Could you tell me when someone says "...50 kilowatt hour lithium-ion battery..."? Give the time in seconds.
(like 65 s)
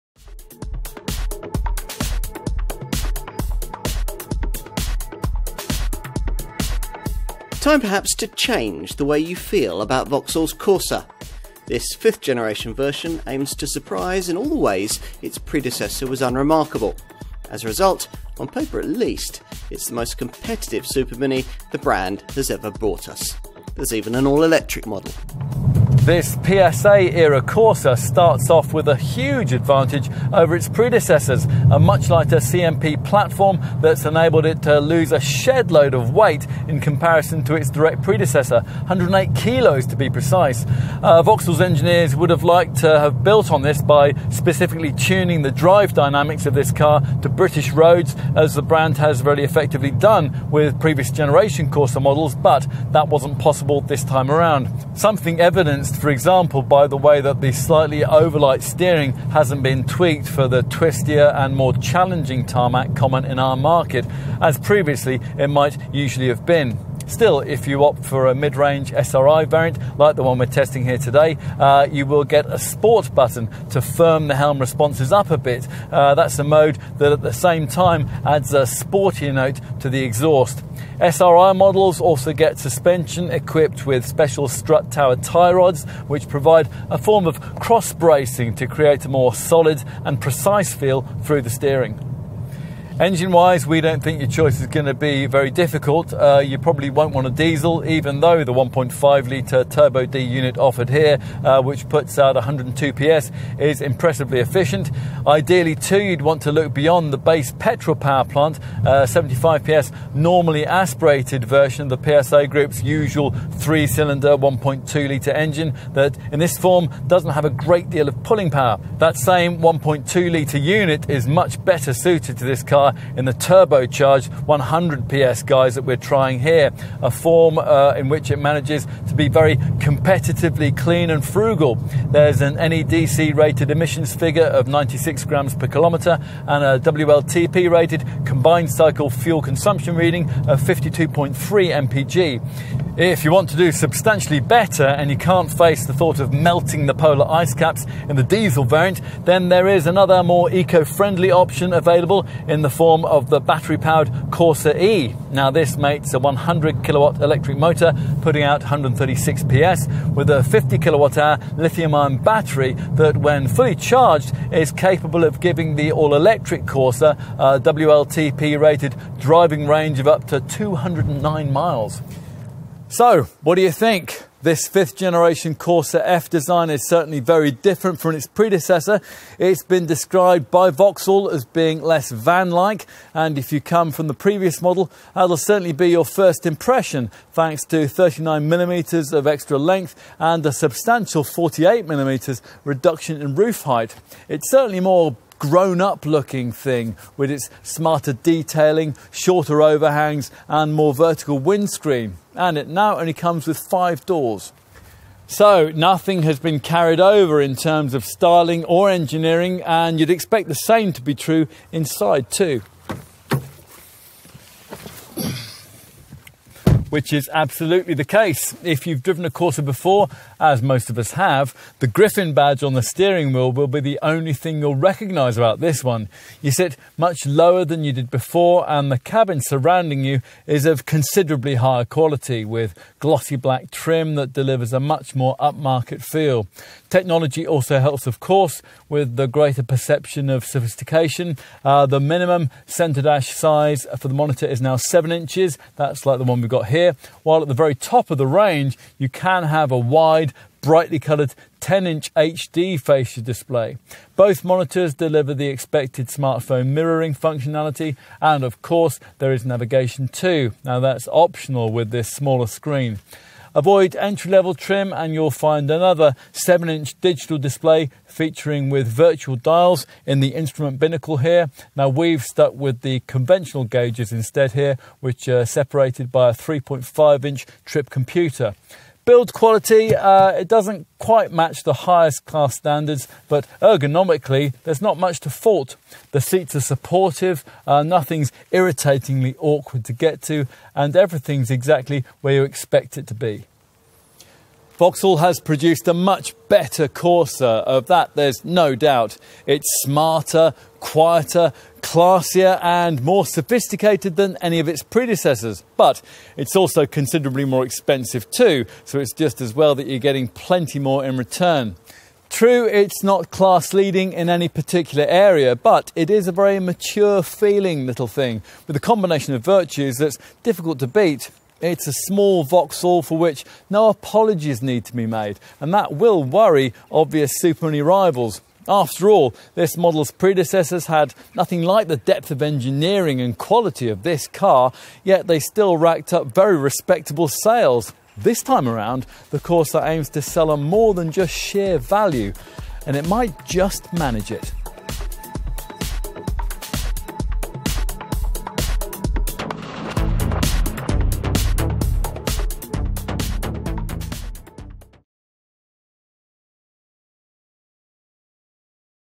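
160 s.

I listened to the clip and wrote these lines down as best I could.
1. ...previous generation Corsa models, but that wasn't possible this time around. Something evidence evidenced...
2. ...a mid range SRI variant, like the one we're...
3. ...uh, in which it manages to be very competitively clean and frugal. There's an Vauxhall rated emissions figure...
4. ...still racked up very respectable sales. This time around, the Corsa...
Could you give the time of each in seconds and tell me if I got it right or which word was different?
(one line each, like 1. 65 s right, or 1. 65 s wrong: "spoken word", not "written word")
1. 50 s right
2. 68 s right
3. 127 s wrong: "NEDC", not "Vauxhall"
4. 335 s right.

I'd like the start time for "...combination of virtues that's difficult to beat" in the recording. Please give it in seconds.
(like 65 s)
318 s.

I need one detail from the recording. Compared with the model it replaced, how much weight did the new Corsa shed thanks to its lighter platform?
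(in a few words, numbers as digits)
108 kilos.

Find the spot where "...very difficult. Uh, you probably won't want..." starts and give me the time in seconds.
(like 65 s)
95 s.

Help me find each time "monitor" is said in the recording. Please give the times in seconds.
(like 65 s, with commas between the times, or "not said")
244 s, 254 s.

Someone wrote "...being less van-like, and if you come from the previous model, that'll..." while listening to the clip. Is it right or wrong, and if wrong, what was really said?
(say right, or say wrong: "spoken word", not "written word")
right.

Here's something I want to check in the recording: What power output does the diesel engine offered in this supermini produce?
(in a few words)
102 PS.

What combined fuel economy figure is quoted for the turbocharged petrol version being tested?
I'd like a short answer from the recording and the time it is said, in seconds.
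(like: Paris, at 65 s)
52.3 mpg, at 140 s.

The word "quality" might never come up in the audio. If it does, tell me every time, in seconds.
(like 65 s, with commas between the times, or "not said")
231 s, 279 s, 333 s.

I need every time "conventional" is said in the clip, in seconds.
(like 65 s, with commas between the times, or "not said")
273 s.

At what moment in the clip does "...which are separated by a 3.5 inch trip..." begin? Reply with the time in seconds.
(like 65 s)
275 s.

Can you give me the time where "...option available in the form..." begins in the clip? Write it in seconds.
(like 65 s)
151 s.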